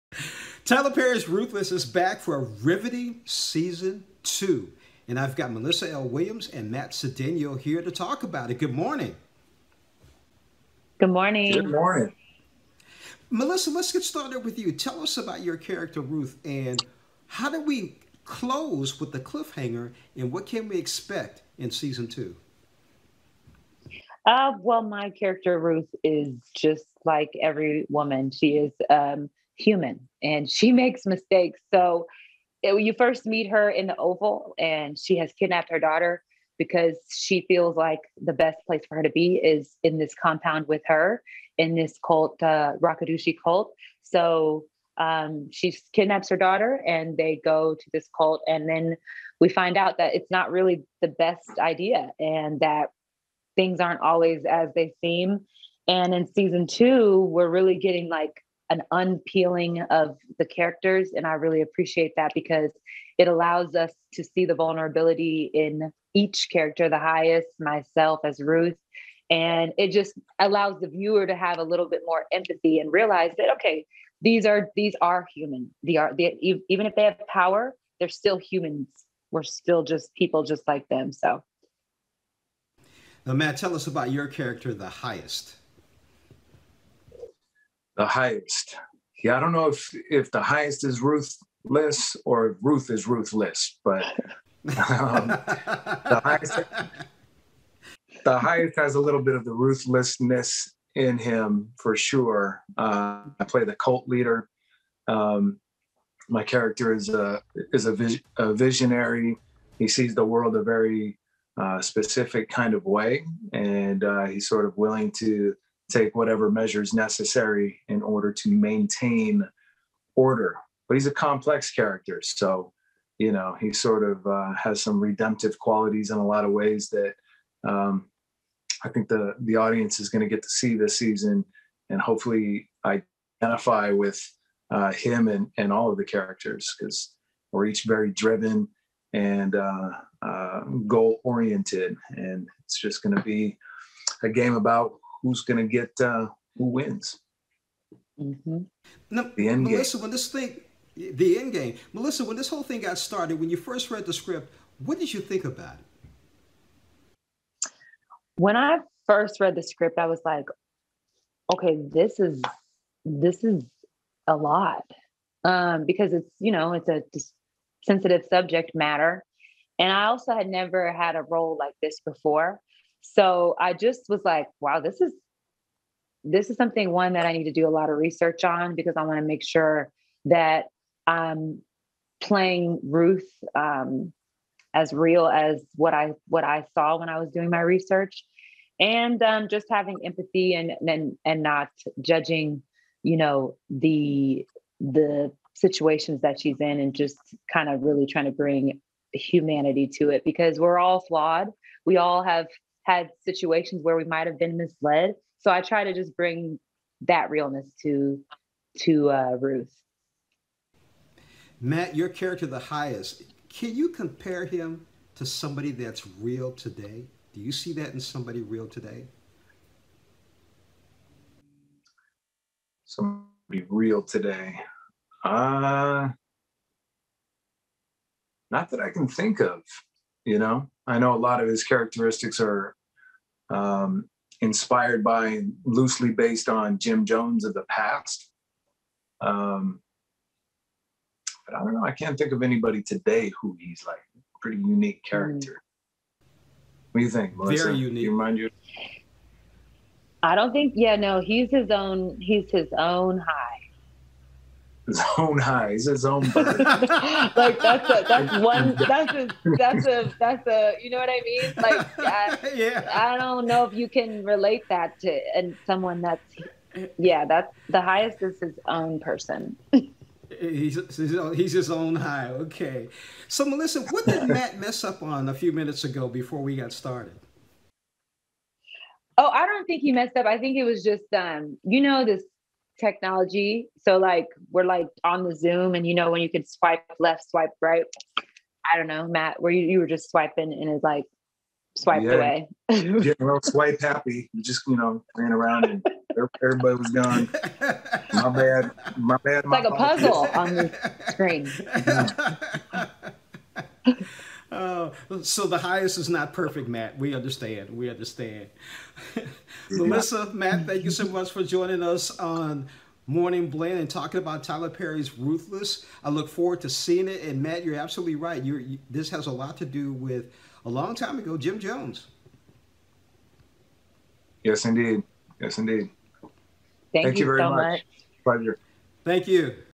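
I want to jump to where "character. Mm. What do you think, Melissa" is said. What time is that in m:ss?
4:05.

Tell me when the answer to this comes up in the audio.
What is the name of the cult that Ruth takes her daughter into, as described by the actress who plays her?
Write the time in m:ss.
0:42.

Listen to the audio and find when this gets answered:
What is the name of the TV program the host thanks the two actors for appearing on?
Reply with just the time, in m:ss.
5:13.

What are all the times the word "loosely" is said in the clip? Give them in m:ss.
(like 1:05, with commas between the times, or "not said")
3:55.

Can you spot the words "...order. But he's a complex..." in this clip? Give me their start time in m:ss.
2:00.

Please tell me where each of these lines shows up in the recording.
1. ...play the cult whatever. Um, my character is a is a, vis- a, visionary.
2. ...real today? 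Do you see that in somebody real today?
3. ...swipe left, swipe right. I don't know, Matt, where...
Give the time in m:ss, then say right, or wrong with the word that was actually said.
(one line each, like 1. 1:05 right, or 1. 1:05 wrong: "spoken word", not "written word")
1. 1:43 wrong: "leader", not "whatever"
2. 3:36 right
3. 4:46 right.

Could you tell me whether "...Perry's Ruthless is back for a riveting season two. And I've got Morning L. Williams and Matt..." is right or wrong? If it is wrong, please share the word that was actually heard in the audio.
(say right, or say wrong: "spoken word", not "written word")
wrong: "Melissa", not "Morning".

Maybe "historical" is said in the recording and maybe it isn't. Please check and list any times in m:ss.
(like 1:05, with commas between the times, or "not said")
not said.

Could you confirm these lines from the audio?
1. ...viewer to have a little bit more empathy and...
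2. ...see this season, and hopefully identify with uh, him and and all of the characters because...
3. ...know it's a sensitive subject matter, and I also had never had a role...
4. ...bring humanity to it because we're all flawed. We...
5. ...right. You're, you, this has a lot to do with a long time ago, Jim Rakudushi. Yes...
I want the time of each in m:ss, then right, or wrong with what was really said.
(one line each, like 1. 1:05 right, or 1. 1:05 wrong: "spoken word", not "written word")
1. 1:10 right
2. 2:10 right
3. 2:46 right
4. 3:18 right
5. 5:18 wrong: "Jones", not "Rakudushi".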